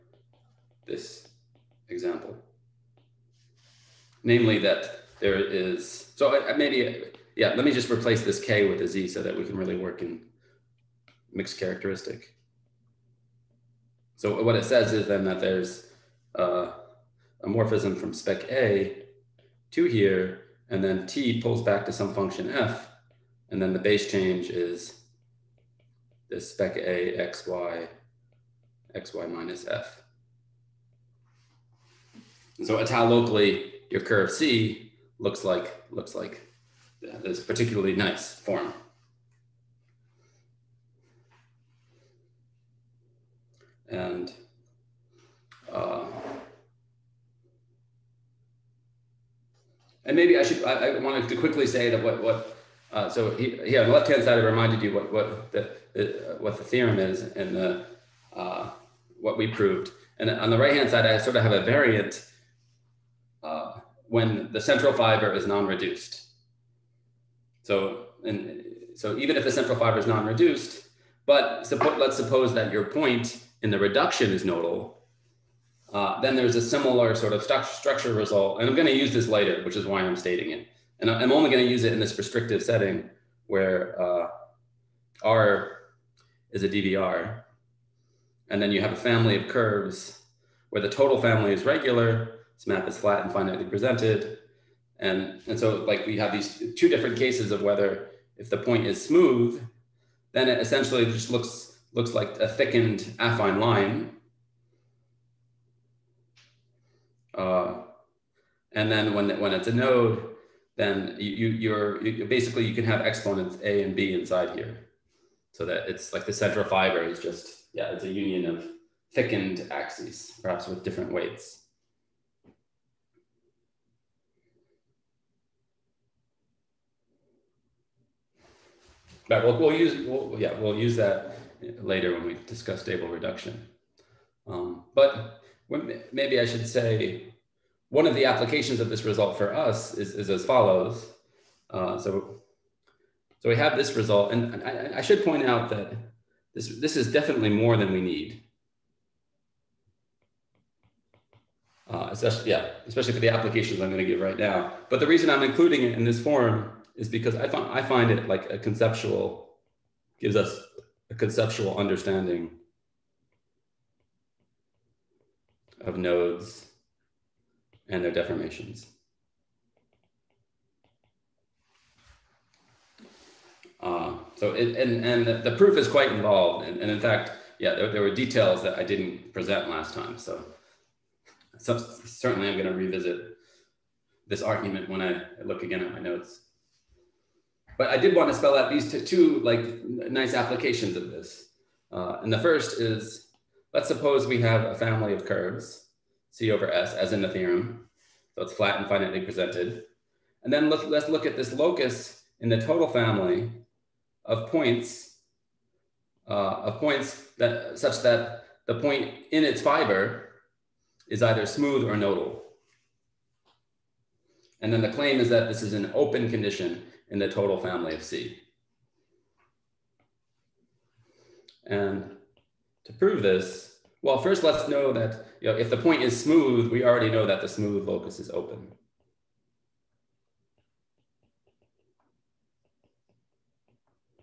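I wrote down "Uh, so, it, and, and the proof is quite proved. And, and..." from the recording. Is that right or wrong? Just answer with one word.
wrong.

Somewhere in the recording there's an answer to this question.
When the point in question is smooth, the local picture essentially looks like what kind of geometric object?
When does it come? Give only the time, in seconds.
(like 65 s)
102 s.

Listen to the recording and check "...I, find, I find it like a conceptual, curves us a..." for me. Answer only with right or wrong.
wrong.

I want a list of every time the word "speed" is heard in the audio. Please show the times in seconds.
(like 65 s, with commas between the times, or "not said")
not said.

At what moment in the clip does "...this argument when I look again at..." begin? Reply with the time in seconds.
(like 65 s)
184 s.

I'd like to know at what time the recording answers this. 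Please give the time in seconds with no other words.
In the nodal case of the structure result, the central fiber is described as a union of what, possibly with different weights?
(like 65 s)
119 s.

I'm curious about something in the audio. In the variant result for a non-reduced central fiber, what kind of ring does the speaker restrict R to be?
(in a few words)
DVR.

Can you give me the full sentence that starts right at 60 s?
And on the right hand side, I sort of have a variant uh, when the central fiber is non-reduced.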